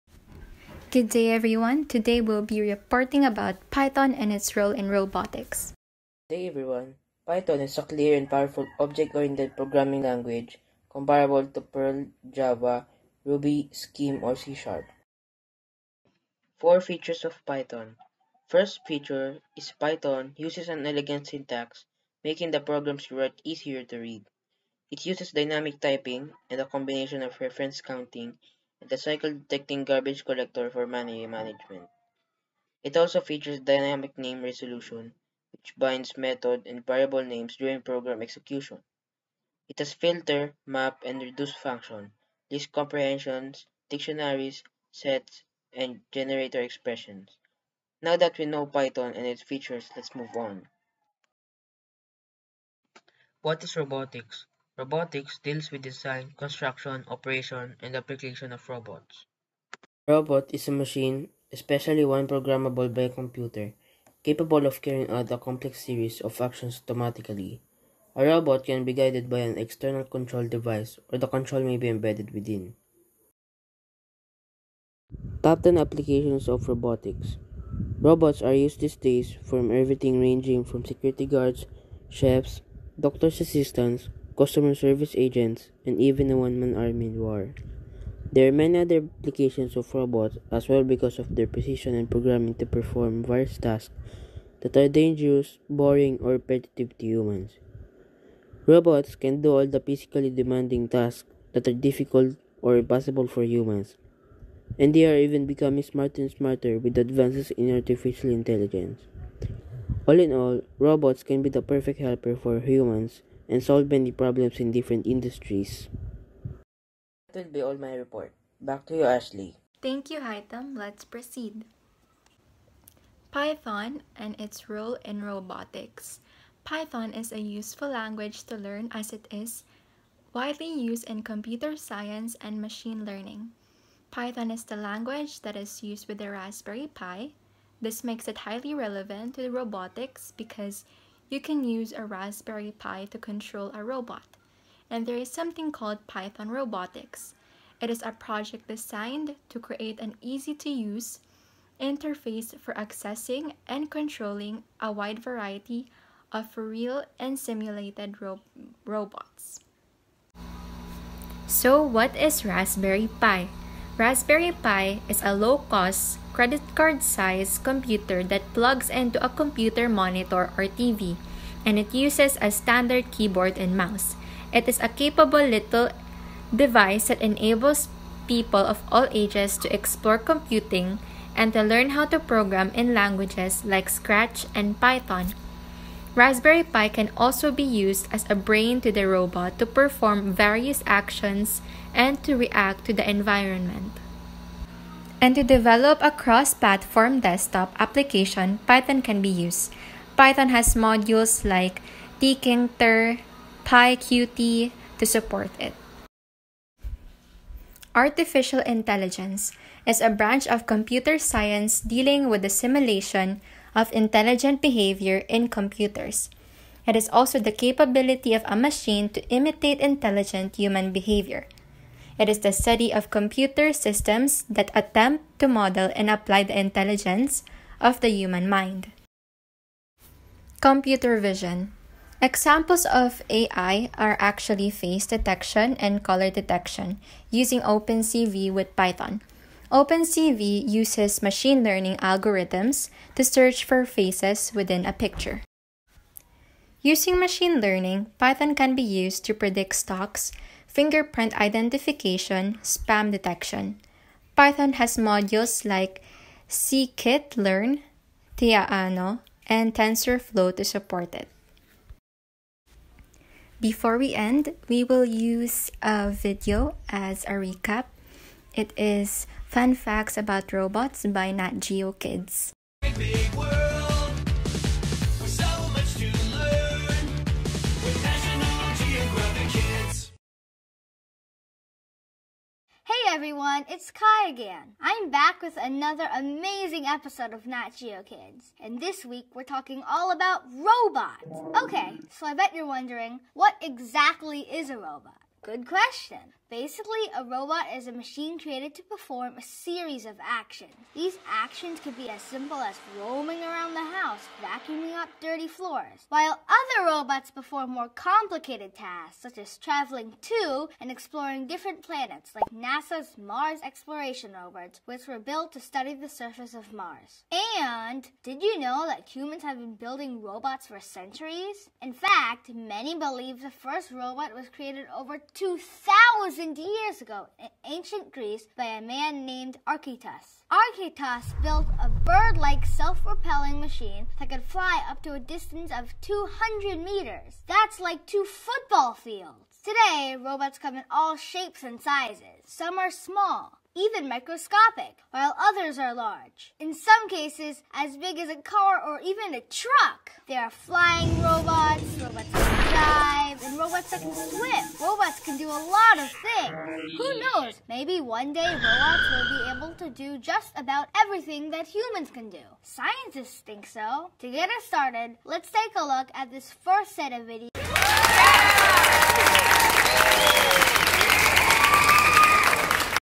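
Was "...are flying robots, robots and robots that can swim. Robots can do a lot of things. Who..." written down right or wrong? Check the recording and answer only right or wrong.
right.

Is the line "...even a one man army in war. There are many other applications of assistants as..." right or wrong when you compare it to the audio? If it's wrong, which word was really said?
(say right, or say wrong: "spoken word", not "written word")
wrong: "robots", not "assistants".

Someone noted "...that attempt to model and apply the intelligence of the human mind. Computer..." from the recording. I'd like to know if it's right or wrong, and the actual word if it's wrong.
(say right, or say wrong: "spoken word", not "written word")
right.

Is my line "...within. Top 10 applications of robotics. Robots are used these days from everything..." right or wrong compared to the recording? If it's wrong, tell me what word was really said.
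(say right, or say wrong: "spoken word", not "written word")
right.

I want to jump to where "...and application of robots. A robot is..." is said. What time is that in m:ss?
0:57.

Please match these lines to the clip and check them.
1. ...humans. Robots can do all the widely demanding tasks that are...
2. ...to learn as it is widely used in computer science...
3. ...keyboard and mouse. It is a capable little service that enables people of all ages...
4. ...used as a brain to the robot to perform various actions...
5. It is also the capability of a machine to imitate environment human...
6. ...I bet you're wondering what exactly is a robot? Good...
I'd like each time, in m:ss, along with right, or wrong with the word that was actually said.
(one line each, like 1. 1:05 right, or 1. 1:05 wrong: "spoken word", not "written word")
1. 1:37 wrong: "physically", not "widely"
2. 2:08 right
3. 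2:53 wrong: "device", not "service"
4. 3:07 right
5. 3:36 wrong: "intelligent", not "environment"
6. 4:52 right.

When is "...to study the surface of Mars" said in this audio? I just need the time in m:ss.
5:15.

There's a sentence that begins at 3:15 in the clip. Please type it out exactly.
And to develop a cross-platform desktop application, Python can be used.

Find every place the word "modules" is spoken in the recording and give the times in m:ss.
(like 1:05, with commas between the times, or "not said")
3:20, 4:14.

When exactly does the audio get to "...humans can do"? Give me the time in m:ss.
6:01.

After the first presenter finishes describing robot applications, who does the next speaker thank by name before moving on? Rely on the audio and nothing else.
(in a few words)
Haitham.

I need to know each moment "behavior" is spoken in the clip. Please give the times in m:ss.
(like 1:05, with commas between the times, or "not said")
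3:34, 3:40.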